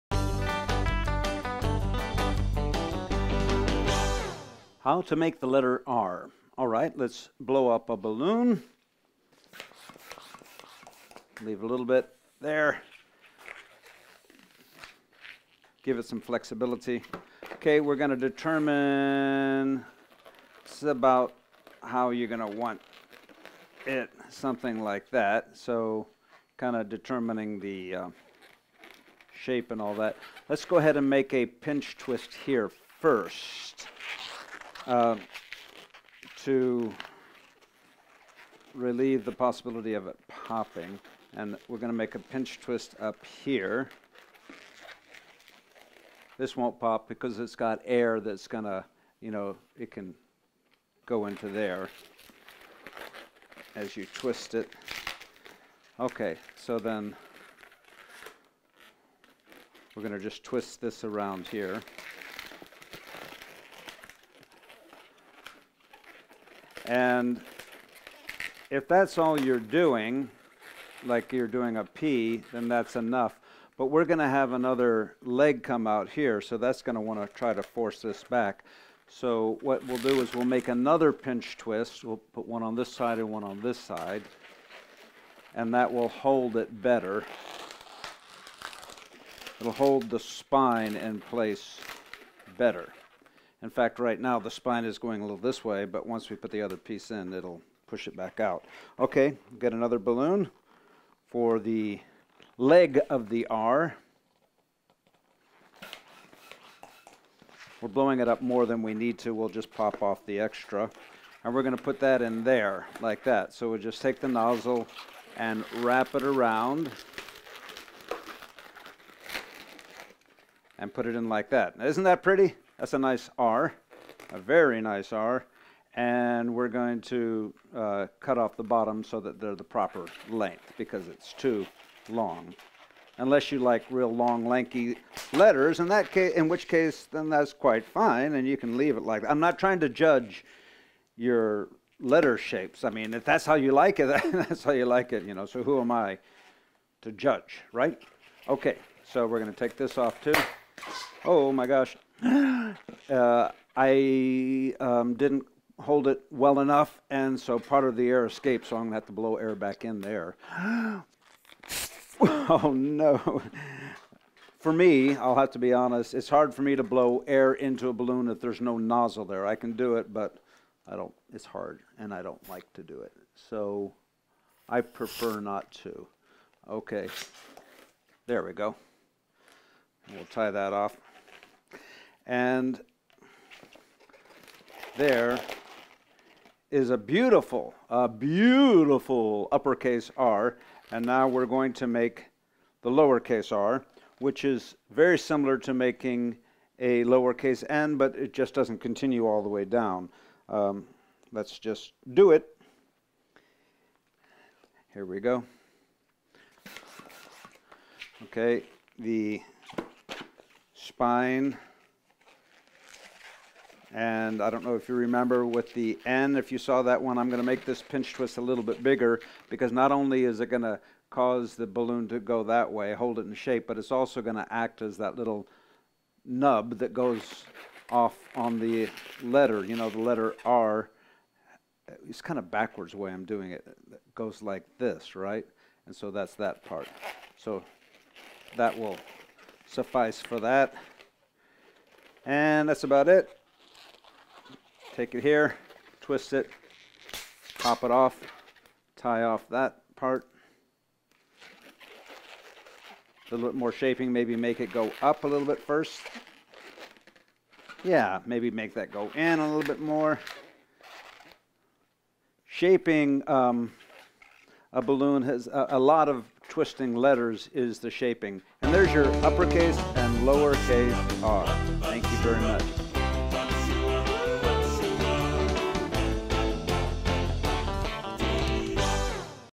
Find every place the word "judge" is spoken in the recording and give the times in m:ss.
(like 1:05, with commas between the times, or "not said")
2:19, 2:27.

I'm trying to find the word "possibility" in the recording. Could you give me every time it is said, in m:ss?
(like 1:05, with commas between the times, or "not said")
0:39.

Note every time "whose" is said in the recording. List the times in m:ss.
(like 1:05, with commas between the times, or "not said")
not said.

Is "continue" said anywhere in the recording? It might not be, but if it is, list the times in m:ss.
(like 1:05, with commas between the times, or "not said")
3:18.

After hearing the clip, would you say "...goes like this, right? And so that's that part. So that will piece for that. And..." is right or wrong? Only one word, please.
wrong.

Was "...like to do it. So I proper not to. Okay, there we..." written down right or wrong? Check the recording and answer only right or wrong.
wrong.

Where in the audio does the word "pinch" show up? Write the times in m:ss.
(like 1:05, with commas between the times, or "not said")
0:31, 0:42, 1:21, 3:37.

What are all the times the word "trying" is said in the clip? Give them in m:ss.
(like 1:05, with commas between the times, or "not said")
2:19.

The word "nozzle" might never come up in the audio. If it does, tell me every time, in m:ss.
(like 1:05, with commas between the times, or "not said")
1:54, 2:48.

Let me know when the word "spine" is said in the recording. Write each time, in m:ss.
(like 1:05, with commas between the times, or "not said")
1:30, 1:34, 3:30.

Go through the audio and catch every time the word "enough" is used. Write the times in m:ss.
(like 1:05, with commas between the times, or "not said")
1:12, 2:36.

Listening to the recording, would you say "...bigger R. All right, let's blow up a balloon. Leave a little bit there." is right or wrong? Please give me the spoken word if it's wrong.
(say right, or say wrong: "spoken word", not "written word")
wrong: "letter", not "bigger".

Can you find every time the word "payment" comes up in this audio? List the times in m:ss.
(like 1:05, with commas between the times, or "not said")
not said.